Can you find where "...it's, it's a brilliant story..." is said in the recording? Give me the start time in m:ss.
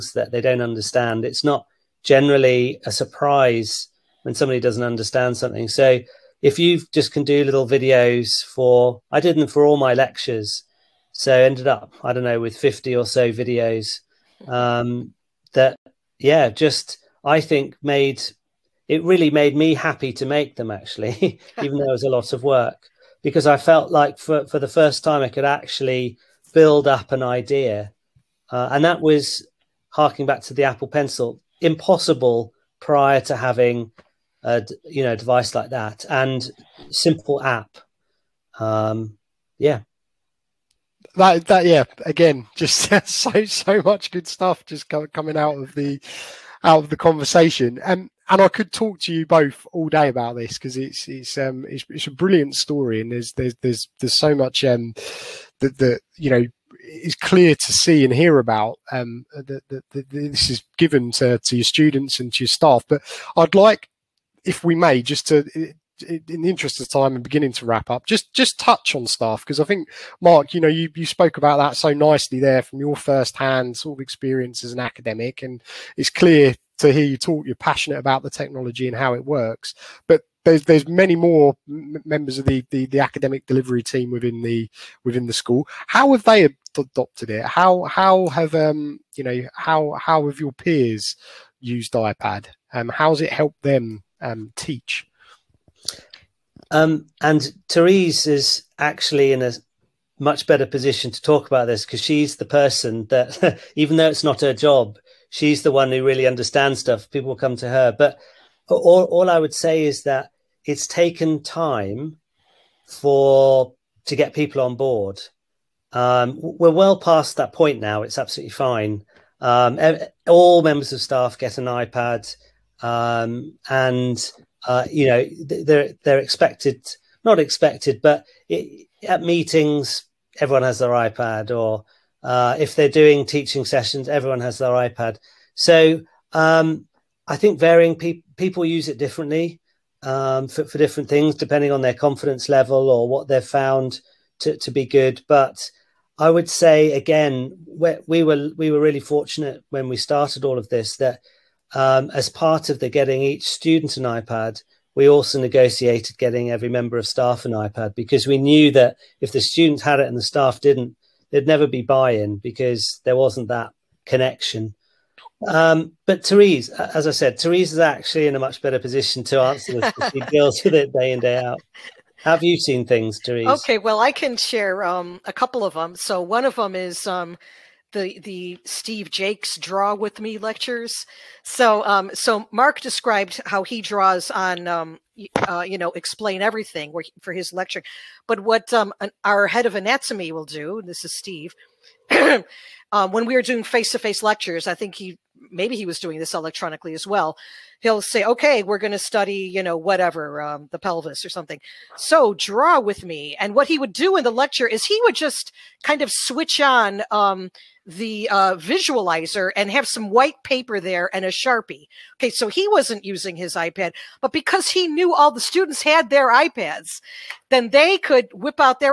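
0:51.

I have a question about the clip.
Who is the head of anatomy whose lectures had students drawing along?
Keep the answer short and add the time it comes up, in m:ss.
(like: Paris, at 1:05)
Steve Jakes, at 2:58.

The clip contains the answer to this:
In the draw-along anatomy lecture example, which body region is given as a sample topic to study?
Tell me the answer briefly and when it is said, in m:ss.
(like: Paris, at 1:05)
pelvis, at 3:20.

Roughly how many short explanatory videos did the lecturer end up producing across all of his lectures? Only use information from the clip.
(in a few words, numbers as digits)
50.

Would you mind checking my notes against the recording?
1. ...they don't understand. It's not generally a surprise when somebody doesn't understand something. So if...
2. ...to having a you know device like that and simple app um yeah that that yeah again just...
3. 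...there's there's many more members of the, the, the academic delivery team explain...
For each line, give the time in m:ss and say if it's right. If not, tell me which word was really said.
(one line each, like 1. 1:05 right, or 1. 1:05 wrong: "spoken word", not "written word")
1. 0:00 right
2. 0:33 right
3. 1:20 wrong: "within", not "explain".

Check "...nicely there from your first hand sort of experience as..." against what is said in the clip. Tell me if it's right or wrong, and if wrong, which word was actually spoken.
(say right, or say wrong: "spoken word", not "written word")
right.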